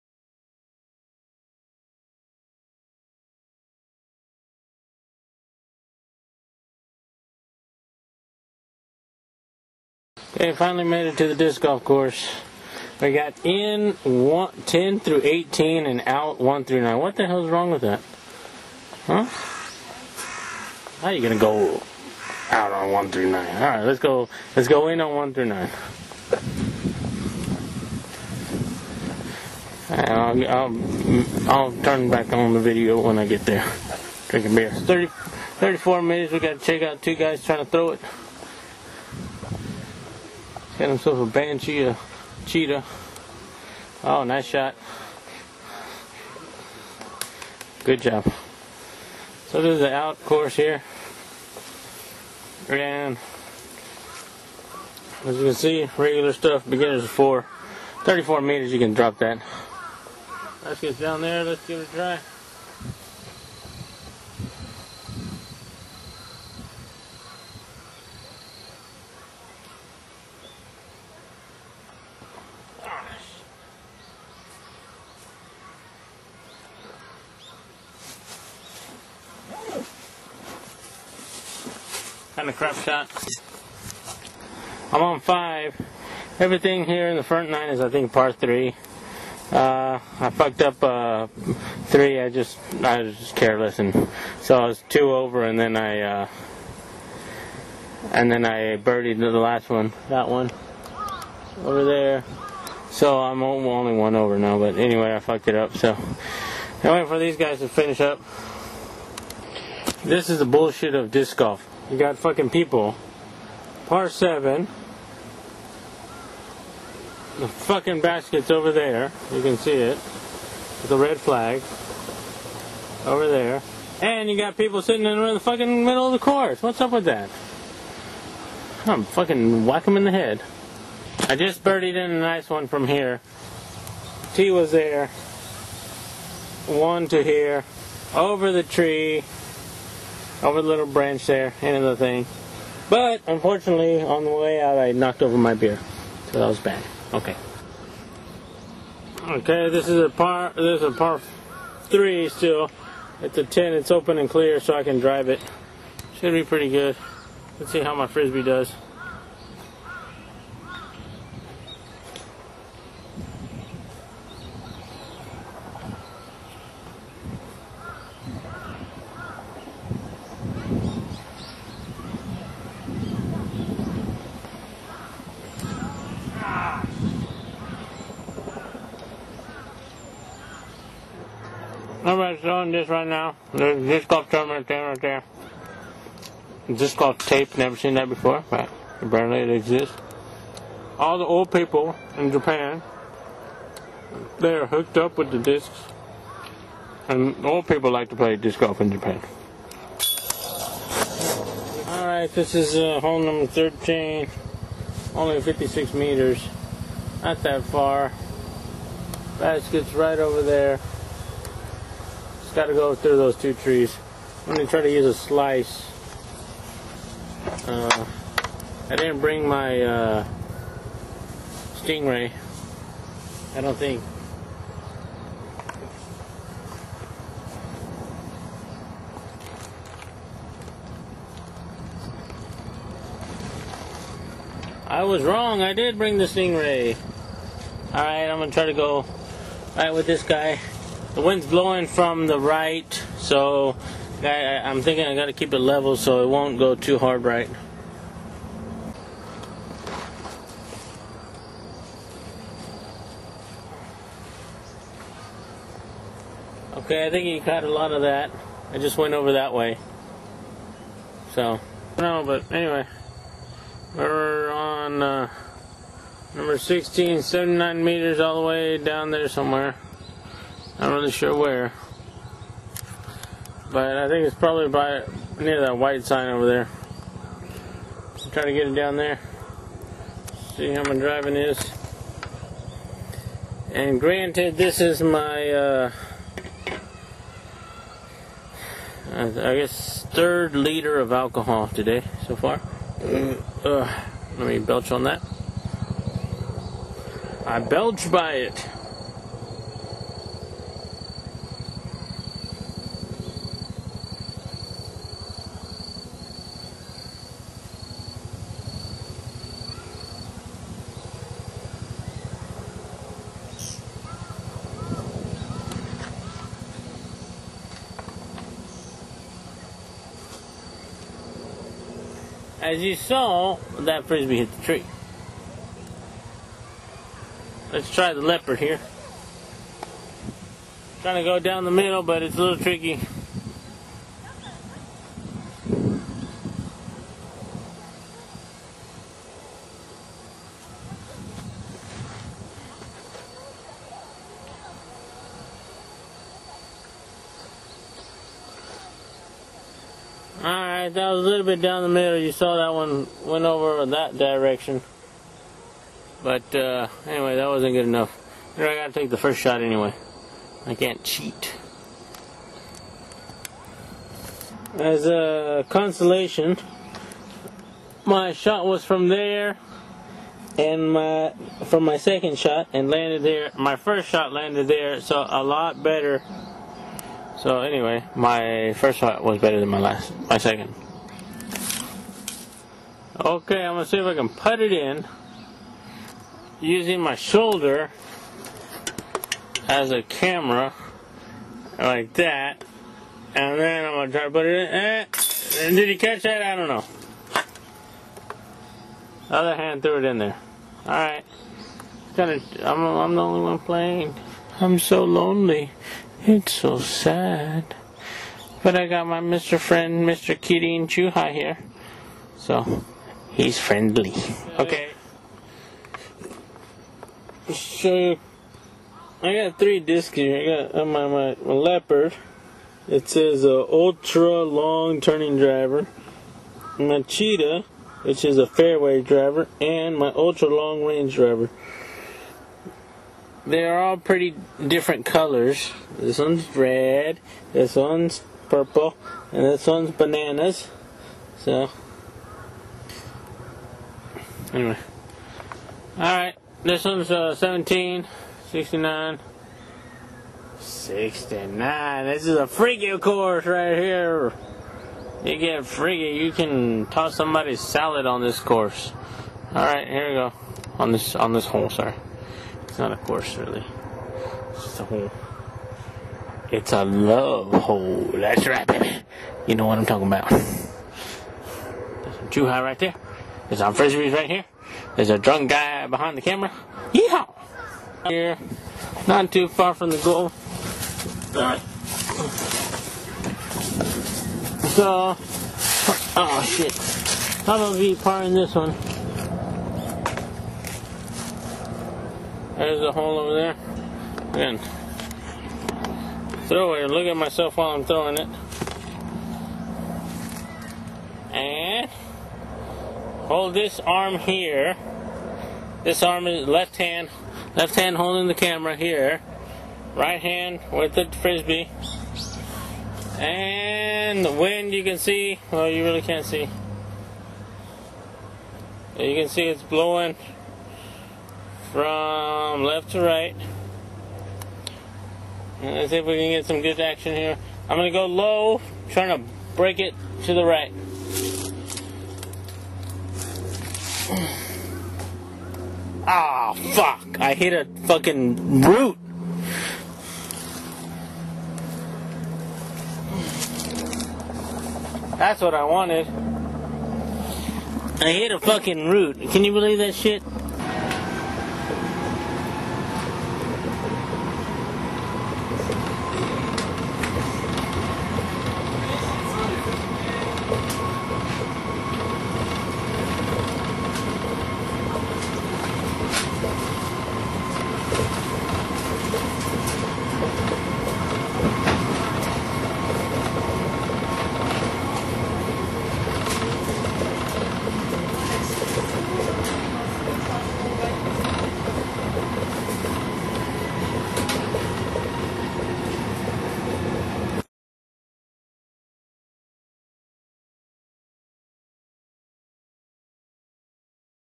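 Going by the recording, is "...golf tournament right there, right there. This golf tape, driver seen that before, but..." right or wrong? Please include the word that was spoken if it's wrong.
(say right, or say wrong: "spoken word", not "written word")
wrong: "never", not "driver".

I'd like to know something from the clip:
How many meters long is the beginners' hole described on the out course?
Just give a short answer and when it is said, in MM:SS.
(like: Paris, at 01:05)
34, at 00:58.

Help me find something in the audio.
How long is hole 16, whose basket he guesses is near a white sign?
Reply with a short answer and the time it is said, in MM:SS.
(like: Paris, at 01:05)
79 meters, at 04:27.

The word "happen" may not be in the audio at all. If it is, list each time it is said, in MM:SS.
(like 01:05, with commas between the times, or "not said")
not said.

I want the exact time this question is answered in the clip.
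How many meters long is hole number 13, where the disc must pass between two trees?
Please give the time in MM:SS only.
03:25.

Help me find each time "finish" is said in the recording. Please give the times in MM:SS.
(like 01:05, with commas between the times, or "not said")
01:47.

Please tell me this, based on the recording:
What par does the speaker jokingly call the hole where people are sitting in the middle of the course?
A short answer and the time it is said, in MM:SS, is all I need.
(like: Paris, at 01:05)
Par 7, at 01:53.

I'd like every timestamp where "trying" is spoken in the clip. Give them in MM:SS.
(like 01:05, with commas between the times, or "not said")
00:37, 04:38, 05:31, 08:48.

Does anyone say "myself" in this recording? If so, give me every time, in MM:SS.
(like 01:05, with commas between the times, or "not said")
08:17.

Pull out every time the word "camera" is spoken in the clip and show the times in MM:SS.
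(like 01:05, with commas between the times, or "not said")
06:30, 07:56, 08:28.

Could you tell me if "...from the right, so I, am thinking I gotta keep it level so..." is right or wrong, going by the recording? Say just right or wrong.
right.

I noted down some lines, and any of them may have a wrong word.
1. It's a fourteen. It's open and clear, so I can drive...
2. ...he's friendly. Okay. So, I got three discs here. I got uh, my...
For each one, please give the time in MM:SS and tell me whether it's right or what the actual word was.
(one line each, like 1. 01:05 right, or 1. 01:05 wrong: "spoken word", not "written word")
1. 02:33 wrong: "ten", not "fourteen"
2. 06:53 right.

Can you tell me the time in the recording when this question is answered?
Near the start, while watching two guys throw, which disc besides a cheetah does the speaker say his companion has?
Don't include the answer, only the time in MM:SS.
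00:41.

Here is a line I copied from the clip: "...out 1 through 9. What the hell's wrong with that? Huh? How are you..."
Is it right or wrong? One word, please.
right.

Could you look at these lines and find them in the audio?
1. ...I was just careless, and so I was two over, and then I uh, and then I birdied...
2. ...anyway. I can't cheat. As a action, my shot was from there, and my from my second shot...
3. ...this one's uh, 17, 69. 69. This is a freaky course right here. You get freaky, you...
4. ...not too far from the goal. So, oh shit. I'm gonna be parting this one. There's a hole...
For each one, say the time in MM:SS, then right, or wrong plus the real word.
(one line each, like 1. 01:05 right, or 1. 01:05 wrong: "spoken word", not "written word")
1. 01:32 right
2. 05:59 wrong: "consolation", not "action"
3. 07:26 right
4. 07:59 right.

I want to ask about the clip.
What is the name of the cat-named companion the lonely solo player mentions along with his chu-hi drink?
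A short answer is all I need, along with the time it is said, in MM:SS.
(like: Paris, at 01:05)
Mr. Kitty, at 06:50.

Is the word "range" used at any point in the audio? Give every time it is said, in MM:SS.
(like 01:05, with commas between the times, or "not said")
07:10.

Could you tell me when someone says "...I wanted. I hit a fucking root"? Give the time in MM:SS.
09:05.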